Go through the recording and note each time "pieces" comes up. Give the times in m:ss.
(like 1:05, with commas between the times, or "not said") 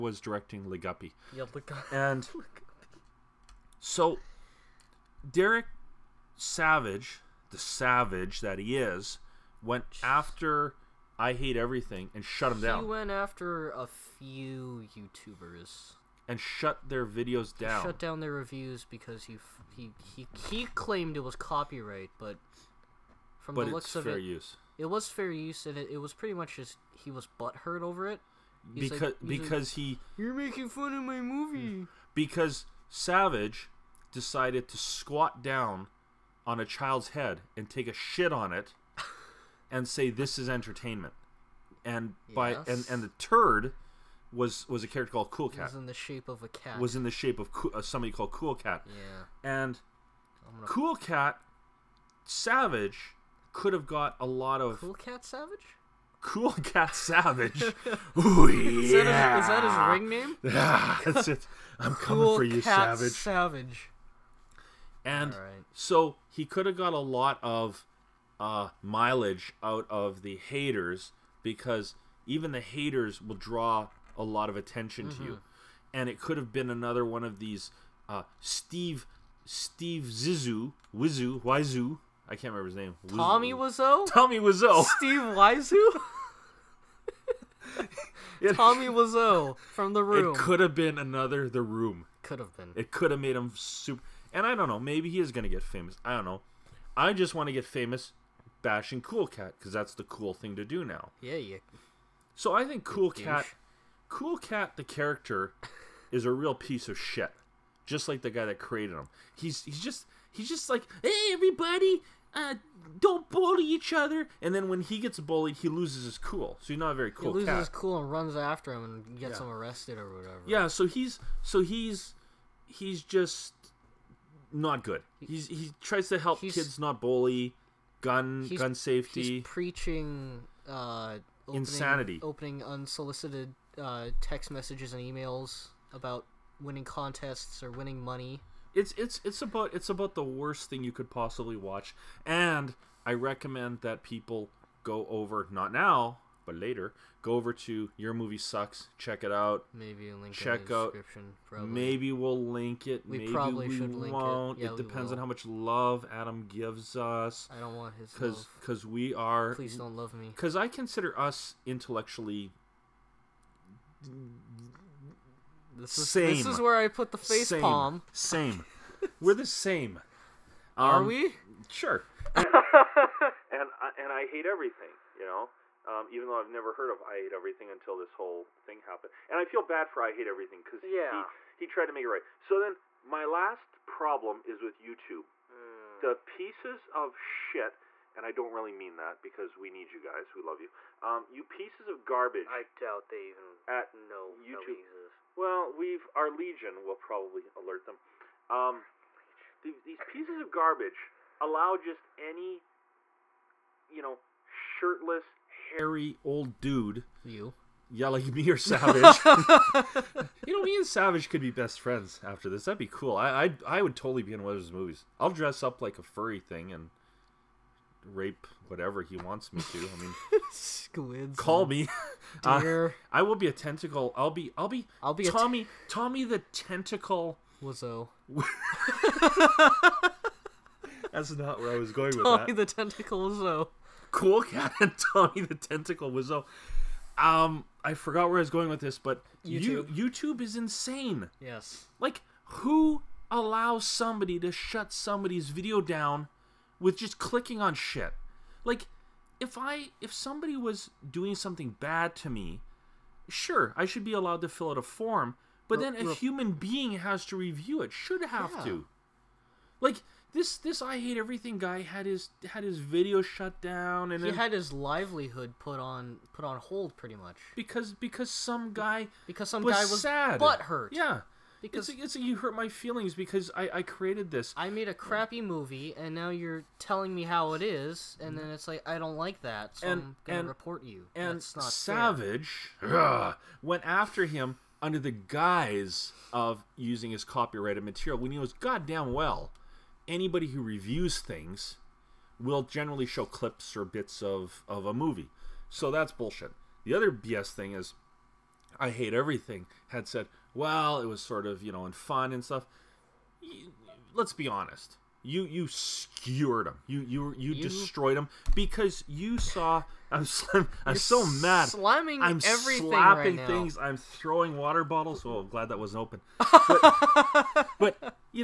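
1:46, 3:06, 3:11, 3:20.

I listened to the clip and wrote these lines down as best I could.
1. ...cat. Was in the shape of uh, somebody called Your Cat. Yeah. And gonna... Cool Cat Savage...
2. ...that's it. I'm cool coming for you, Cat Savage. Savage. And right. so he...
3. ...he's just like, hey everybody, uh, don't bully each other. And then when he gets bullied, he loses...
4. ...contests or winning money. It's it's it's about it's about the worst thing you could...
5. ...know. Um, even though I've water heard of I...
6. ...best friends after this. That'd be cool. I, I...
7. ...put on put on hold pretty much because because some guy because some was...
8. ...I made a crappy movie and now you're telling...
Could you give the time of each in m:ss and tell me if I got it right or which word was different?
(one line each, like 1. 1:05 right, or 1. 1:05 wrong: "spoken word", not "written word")
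1. 0:46 wrong: "Cool", not "Your"
2. 1:01 right
3. 1:50 right
4. 2:16 right
5. 2:55 wrong: "never", not "water"
6. 3:31 right
7. 4:25 right
8. 4:34 right.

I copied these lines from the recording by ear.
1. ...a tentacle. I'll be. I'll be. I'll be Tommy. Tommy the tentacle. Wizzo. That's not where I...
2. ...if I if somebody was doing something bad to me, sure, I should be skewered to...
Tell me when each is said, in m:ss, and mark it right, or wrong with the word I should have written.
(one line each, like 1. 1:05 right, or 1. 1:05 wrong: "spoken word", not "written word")
1. 3:43 right
2. 4:09 wrong: "allowed", not "skewered".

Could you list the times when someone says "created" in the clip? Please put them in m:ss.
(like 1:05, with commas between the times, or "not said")
1:48, 4:33.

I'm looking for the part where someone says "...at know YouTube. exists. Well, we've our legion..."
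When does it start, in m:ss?
3:13.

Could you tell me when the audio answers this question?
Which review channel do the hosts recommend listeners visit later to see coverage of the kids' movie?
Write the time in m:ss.
2:27.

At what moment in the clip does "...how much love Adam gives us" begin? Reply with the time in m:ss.
2:35.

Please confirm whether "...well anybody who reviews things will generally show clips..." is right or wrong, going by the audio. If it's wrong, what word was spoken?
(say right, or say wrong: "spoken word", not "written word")
right.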